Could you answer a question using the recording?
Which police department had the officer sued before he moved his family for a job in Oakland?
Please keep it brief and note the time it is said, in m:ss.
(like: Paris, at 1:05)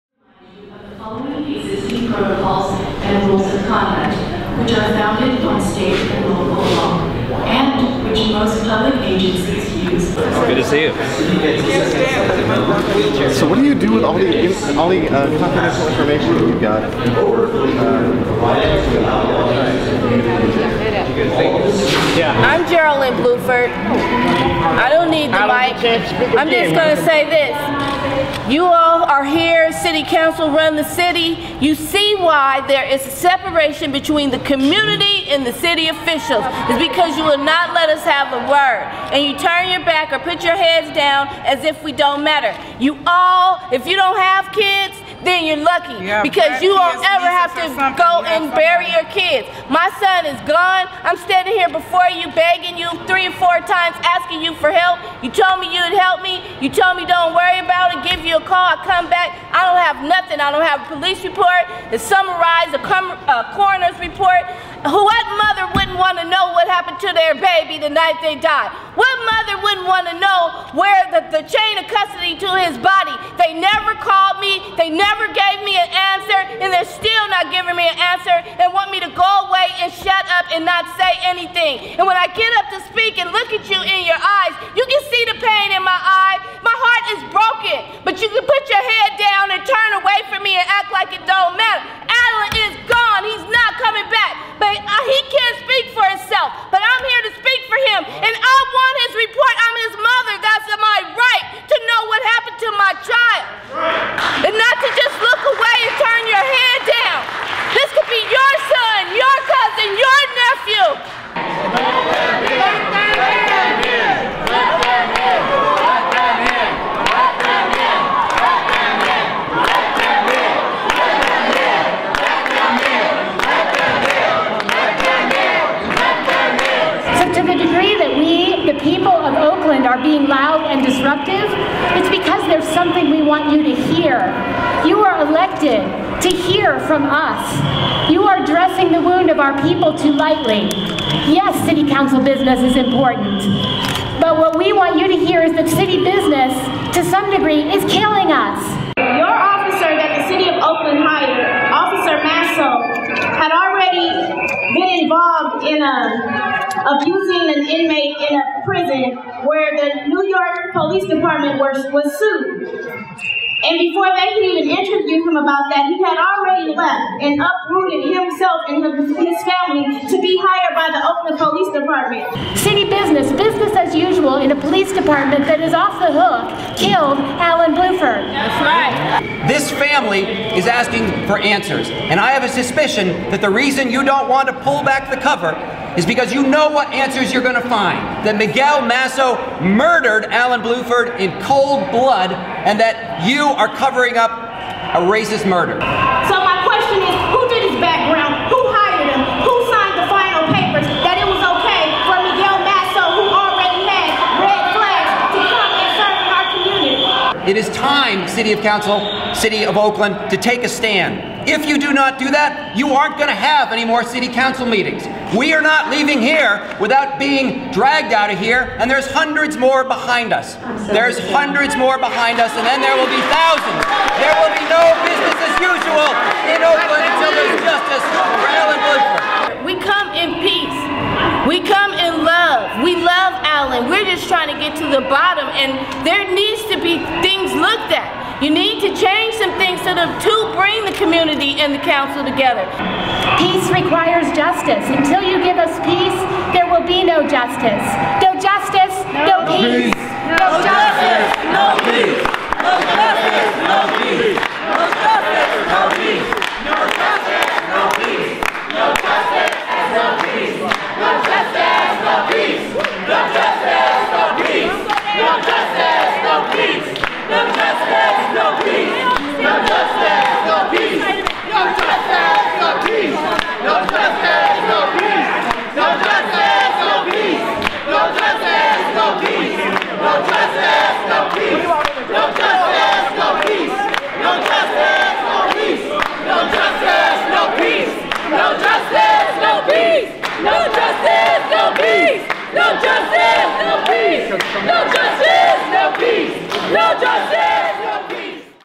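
New York Police Department, at 2:40.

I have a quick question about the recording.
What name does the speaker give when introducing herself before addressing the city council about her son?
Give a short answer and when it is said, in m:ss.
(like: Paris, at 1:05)
Geraldine Blueford, at 0:22.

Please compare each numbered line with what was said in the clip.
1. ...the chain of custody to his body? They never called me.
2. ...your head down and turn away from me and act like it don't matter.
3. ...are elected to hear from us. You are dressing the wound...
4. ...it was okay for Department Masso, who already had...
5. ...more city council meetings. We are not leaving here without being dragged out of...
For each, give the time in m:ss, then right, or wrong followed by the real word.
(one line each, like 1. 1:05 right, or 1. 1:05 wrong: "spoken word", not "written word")
1. 1:11 right
2. 1:28 right
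3. 2:15 right
4. 3:21 wrong: "Miguel", not "Department"
5. 3:33 right.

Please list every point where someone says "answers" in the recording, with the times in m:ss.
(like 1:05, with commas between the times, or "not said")
3:01, 3:06.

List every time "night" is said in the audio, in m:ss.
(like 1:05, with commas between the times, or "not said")
1:07.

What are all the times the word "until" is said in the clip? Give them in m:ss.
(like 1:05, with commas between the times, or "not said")
3:47, 4:04.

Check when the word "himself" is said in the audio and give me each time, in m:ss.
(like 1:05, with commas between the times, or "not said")
1:36, 2:48.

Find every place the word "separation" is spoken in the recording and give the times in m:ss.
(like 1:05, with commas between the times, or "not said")
0:33.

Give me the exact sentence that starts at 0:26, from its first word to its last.
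I'm just going to say this.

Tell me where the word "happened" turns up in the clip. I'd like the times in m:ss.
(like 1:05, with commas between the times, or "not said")
1:06, 1:42.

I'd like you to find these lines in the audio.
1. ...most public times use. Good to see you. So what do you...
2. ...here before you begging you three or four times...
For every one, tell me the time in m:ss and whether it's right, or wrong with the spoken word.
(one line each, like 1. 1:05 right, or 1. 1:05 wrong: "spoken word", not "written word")
1. 0:08 wrong: "agencies", not "times"
2. 0:51 right.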